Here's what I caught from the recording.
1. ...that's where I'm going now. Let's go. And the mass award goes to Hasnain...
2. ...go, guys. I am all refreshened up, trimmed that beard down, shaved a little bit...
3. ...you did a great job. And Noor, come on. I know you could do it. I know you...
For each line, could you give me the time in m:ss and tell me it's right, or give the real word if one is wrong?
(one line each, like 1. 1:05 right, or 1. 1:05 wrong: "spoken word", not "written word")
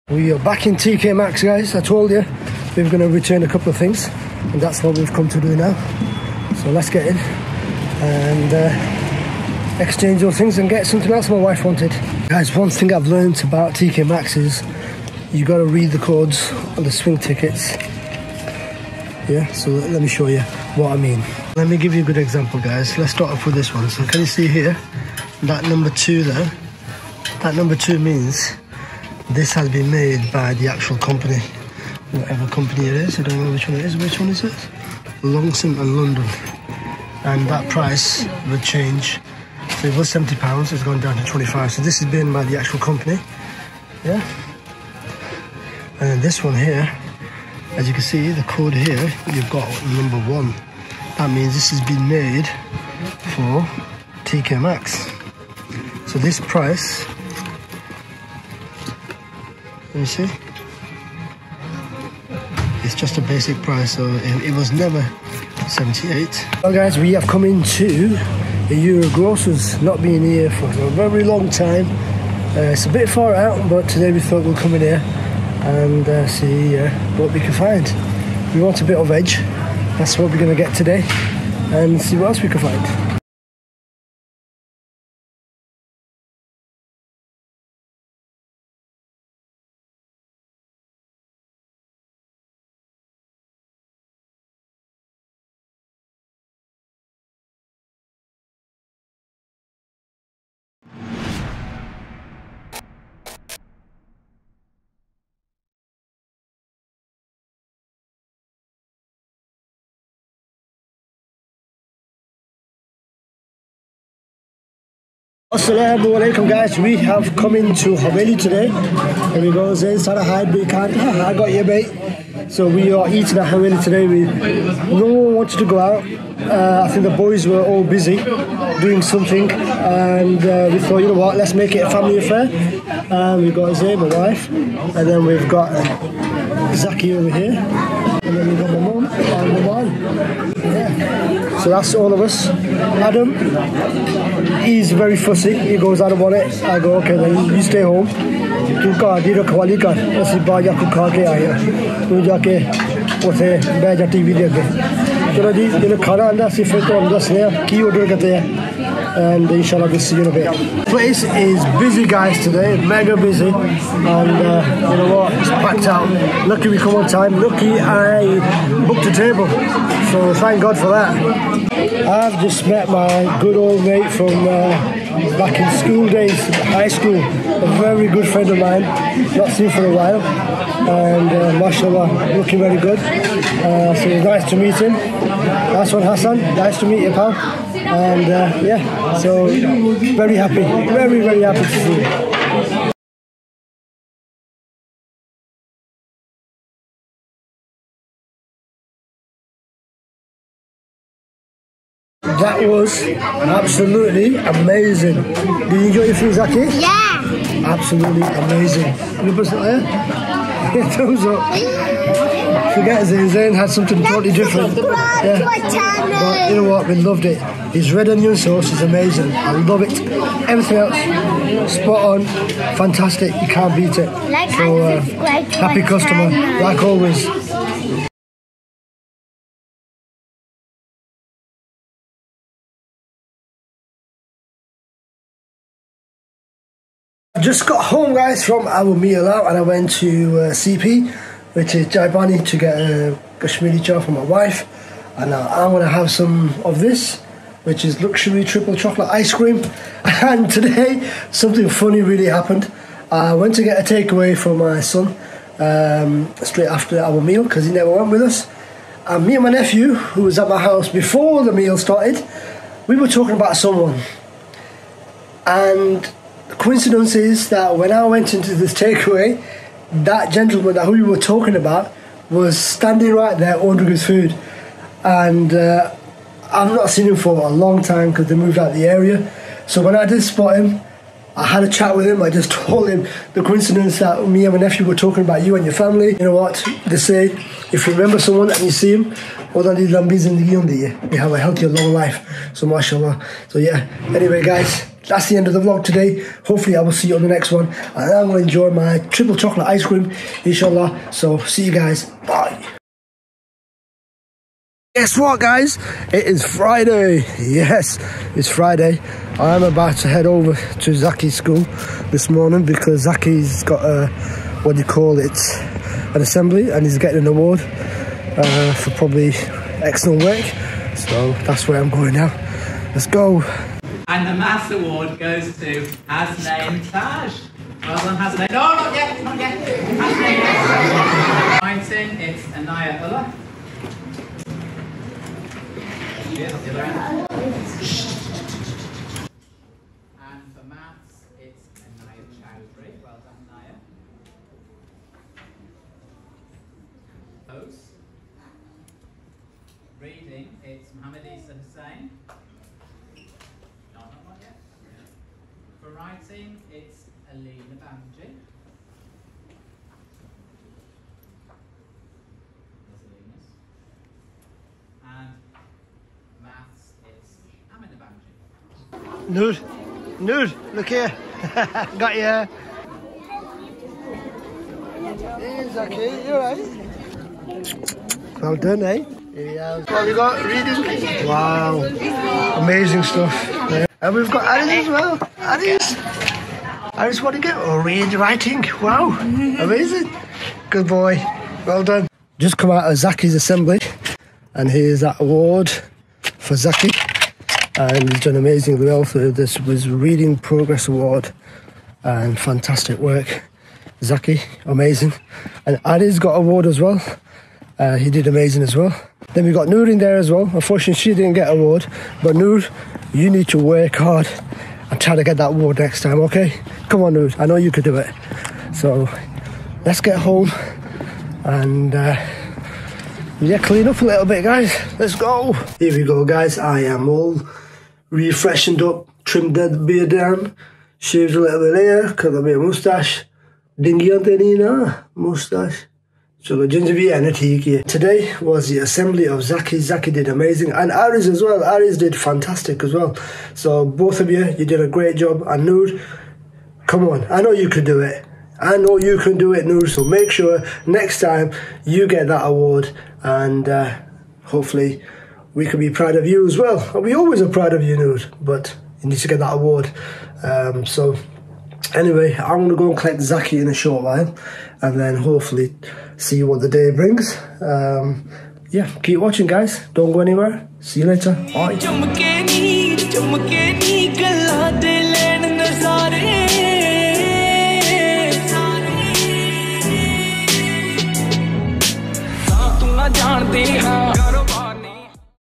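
1. 5:21 right
2. 7:06 right
3. 7:24 right.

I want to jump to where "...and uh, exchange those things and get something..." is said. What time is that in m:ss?
0:07.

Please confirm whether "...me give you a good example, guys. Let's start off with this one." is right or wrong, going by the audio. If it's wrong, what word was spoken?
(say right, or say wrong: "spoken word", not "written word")
right.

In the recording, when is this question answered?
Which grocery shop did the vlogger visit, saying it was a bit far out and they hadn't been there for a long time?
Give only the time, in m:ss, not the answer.
1:08.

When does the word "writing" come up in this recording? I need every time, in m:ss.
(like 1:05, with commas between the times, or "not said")
5:55, 6:28.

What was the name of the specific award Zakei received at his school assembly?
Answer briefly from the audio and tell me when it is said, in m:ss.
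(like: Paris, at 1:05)
Reading Progress Award, at 6:39.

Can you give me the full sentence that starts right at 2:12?
And um, we've got Zay, my wife, and then we've got uh, Zakei over here.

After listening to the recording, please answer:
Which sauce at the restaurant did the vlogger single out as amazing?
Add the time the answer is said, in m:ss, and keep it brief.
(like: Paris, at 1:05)
Red onion sauce, at 3:37.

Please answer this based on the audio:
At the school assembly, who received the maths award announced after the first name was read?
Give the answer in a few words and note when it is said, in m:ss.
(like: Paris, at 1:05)
Anaya Chowdhury, at 5:41.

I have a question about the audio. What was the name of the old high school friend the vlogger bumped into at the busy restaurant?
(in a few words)
Hassan.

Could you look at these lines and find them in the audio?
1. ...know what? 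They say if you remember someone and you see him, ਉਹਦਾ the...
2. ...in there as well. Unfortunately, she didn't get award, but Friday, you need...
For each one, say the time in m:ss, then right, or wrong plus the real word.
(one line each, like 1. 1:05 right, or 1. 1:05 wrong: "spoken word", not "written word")
1. 4:46 right
2. 6:49 wrong: "Noor", not "Friday".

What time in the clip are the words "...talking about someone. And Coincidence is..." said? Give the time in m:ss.
4:23.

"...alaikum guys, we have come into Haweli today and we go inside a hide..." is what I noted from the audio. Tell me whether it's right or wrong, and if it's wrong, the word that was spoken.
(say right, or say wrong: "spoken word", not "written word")
right.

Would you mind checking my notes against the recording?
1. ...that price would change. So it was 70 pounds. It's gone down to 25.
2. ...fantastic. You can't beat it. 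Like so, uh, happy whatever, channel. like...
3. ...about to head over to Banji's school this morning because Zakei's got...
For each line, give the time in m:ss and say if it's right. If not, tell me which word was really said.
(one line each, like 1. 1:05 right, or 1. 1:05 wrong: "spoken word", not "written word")
1. 0:37 right
2. 3:42 wrong: "customer", not "whatever"
3. 5:09 wrong: "Zakei", not "Banji".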